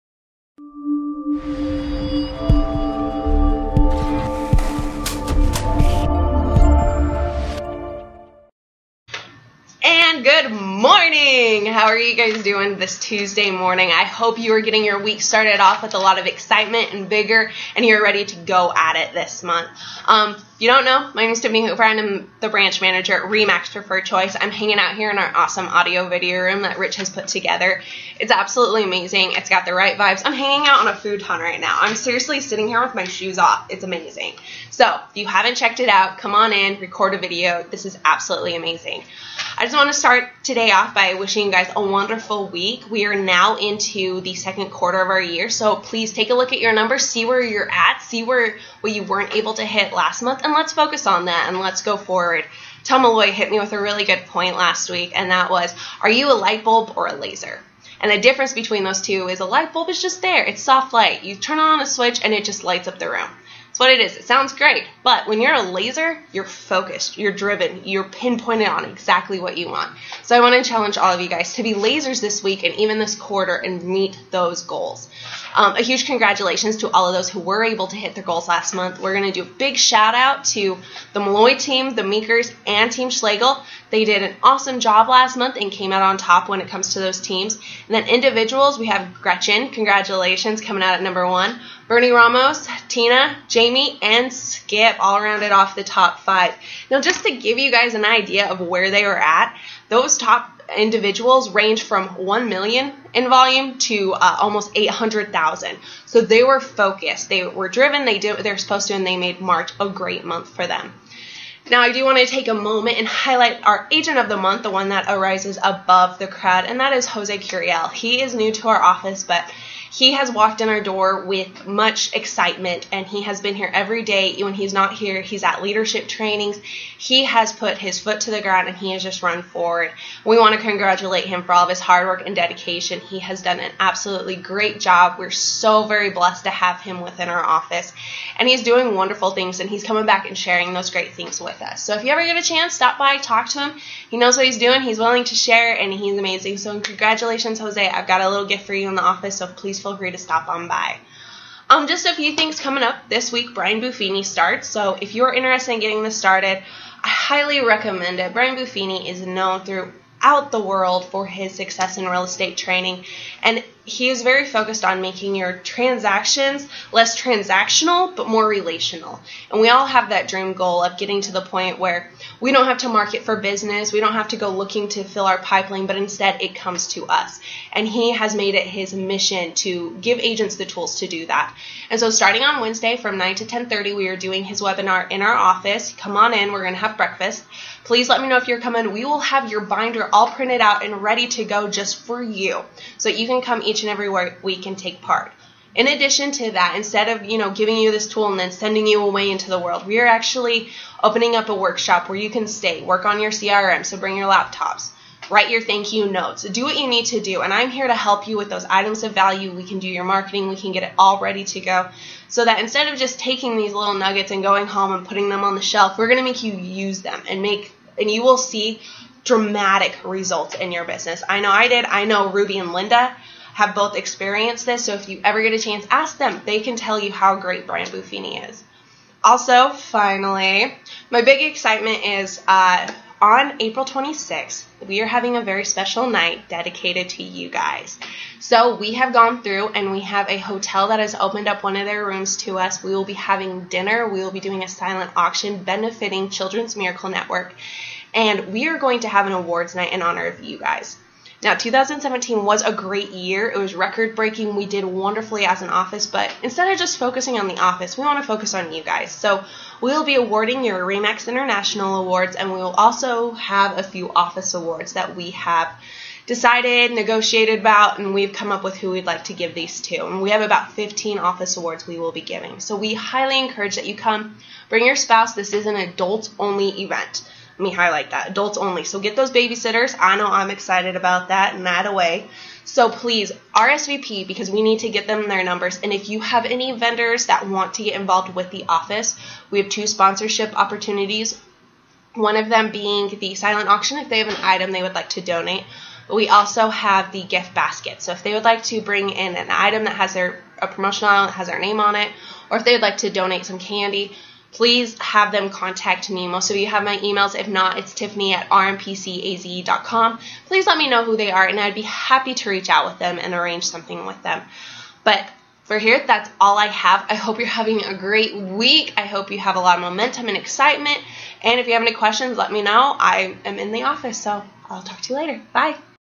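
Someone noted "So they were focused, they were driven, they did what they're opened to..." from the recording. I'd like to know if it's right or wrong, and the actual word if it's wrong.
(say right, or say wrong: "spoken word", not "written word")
wrong: "supposed", not "opened".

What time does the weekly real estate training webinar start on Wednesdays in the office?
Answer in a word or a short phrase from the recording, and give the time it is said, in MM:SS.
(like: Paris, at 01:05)
9, at 03:03.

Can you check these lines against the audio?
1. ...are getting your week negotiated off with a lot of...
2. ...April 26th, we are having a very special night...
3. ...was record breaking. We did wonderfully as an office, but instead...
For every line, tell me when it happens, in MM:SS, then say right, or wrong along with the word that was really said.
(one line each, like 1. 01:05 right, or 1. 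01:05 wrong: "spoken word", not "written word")
1. 00:14 wrong: "started", not "negotiated"
2. 03:53 right
3. 04:13 right.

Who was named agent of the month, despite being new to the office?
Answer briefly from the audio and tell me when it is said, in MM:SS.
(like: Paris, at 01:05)
Jose Curiel, at 01:57.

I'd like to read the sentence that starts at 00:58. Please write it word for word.
And the difference between those two is a light bulb is just there, it's soft light.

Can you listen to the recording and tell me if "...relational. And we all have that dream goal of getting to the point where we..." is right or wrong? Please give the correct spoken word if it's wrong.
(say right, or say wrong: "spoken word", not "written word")
right.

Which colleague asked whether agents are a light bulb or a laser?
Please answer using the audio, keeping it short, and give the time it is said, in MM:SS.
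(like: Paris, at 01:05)
Tom Malloy, at 00:52.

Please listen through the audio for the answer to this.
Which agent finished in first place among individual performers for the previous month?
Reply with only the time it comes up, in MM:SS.
01:29.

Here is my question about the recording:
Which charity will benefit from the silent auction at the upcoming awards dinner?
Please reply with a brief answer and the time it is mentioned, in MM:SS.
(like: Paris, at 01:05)
Children's Miracle Network, at 04:06.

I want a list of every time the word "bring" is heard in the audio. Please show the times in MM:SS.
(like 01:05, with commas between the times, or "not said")
03:23, 04:34, 04:58.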